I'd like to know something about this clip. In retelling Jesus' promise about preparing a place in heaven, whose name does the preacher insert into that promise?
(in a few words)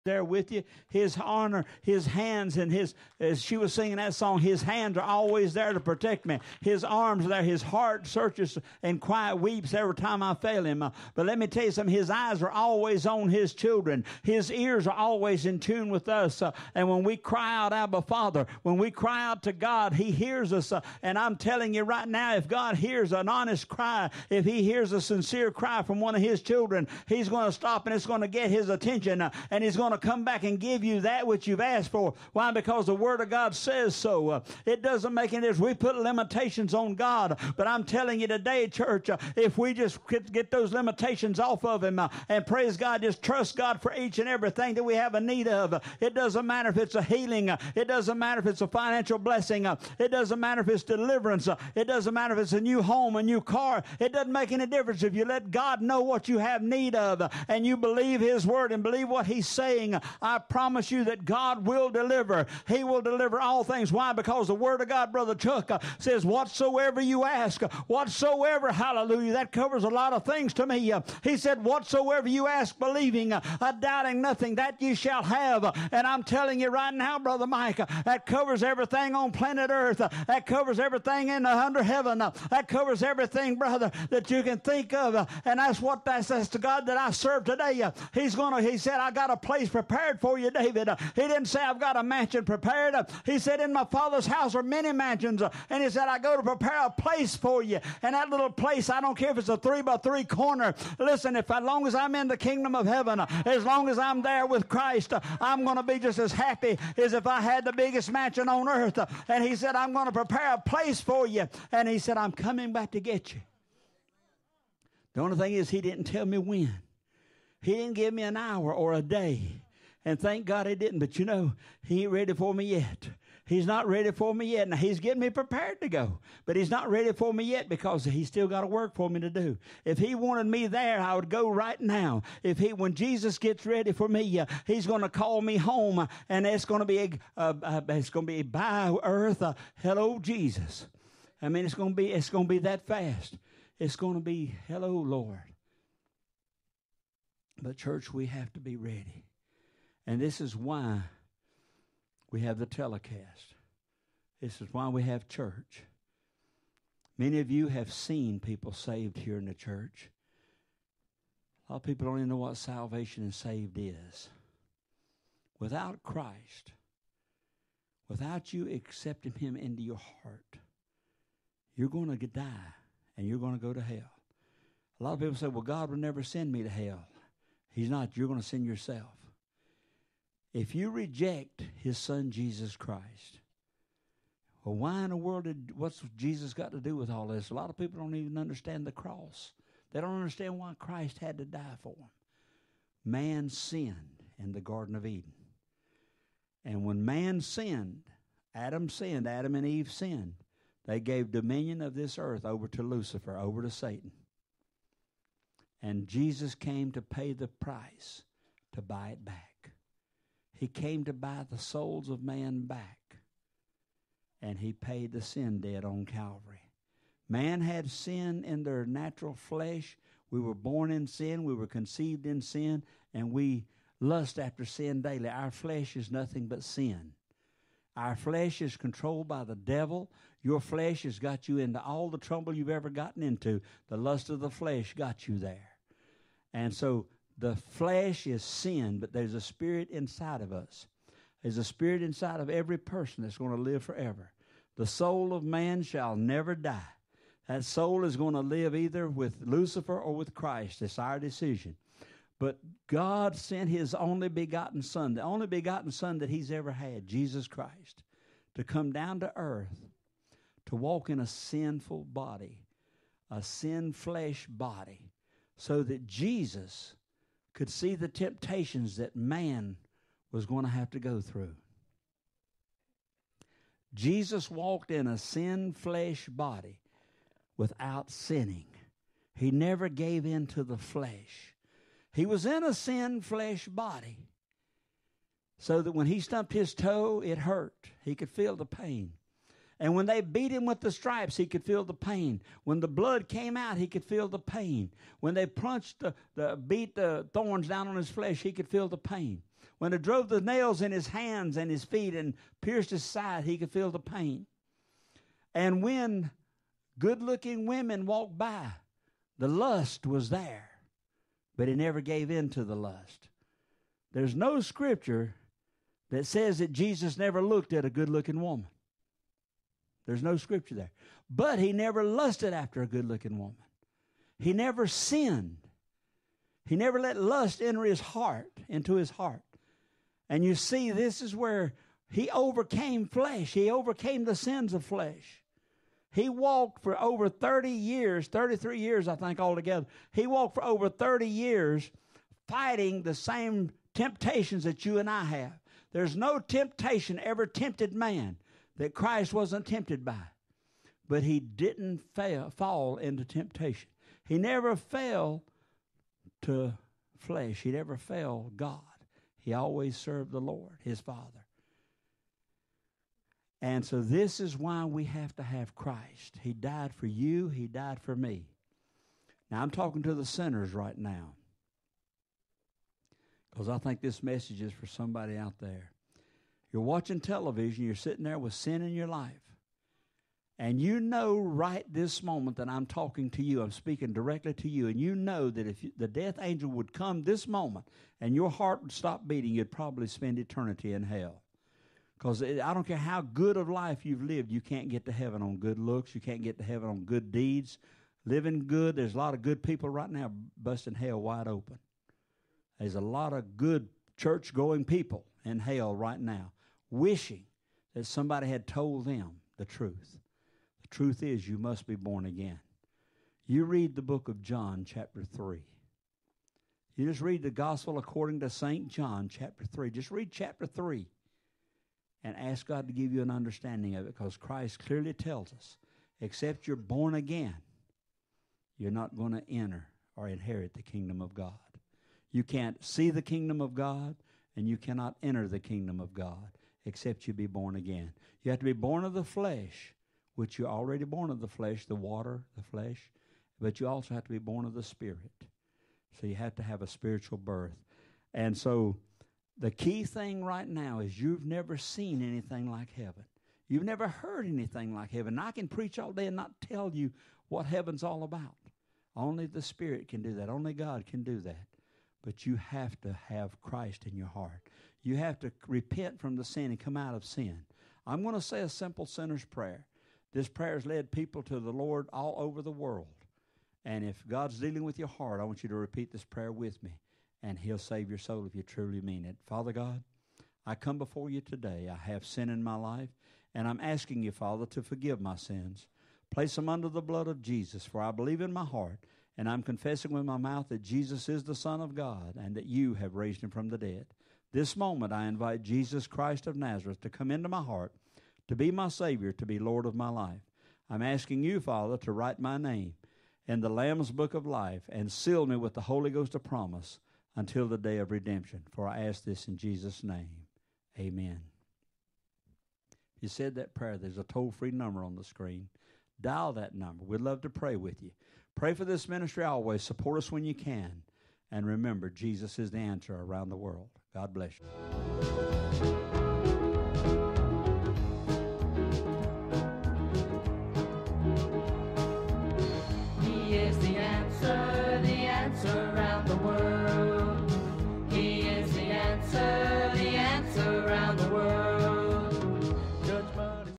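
David.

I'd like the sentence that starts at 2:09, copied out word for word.
If he wanted me there, I would go right now.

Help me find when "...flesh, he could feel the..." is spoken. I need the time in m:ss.
4:58.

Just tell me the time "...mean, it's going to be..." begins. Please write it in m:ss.
2:21.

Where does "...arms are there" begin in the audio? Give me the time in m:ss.
0:06.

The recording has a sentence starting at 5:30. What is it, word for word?
And you see, this is where he overcame flesh.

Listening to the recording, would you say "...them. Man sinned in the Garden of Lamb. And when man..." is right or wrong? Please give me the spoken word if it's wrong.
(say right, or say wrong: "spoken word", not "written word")
wrong: "Eden", not "Lamb".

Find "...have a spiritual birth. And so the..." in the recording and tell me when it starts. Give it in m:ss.
7:26.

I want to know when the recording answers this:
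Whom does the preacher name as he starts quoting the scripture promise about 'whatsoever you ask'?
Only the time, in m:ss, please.
1:05.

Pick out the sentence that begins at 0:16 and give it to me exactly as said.
Uh, and when we cry out, Abba Father, when we cry out to God, he hears us.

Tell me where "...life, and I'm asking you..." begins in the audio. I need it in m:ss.
8:02.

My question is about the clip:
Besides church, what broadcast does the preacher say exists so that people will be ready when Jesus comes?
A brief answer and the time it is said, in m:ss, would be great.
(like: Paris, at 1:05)
telecast, at 2:32.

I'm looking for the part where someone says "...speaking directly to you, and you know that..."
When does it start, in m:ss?
6:23.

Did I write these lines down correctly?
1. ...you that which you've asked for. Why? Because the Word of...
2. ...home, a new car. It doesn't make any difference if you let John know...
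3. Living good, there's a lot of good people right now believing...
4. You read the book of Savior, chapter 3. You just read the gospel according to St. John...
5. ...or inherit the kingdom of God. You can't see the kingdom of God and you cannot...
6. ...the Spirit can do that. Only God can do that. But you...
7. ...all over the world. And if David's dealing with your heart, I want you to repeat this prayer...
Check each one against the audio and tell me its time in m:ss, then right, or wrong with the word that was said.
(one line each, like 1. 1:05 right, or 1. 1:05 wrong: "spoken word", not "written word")
1. 0:30 right
2. 0:52 wrong: "God", not "John"
3. 6:38 wrong: "busting", not "believing"
4. 6:53 wrong: "John", not "Savior"
5. 7:10 right
6. 7:39 right
7. 7:52 wrong: "God", not "David".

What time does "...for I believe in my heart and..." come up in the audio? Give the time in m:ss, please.
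8:07.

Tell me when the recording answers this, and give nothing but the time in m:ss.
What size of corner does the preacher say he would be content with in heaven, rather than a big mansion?
1:39.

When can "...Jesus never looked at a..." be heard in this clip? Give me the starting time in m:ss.
5:16.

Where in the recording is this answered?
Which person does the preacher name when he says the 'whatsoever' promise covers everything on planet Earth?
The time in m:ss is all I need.
1:17.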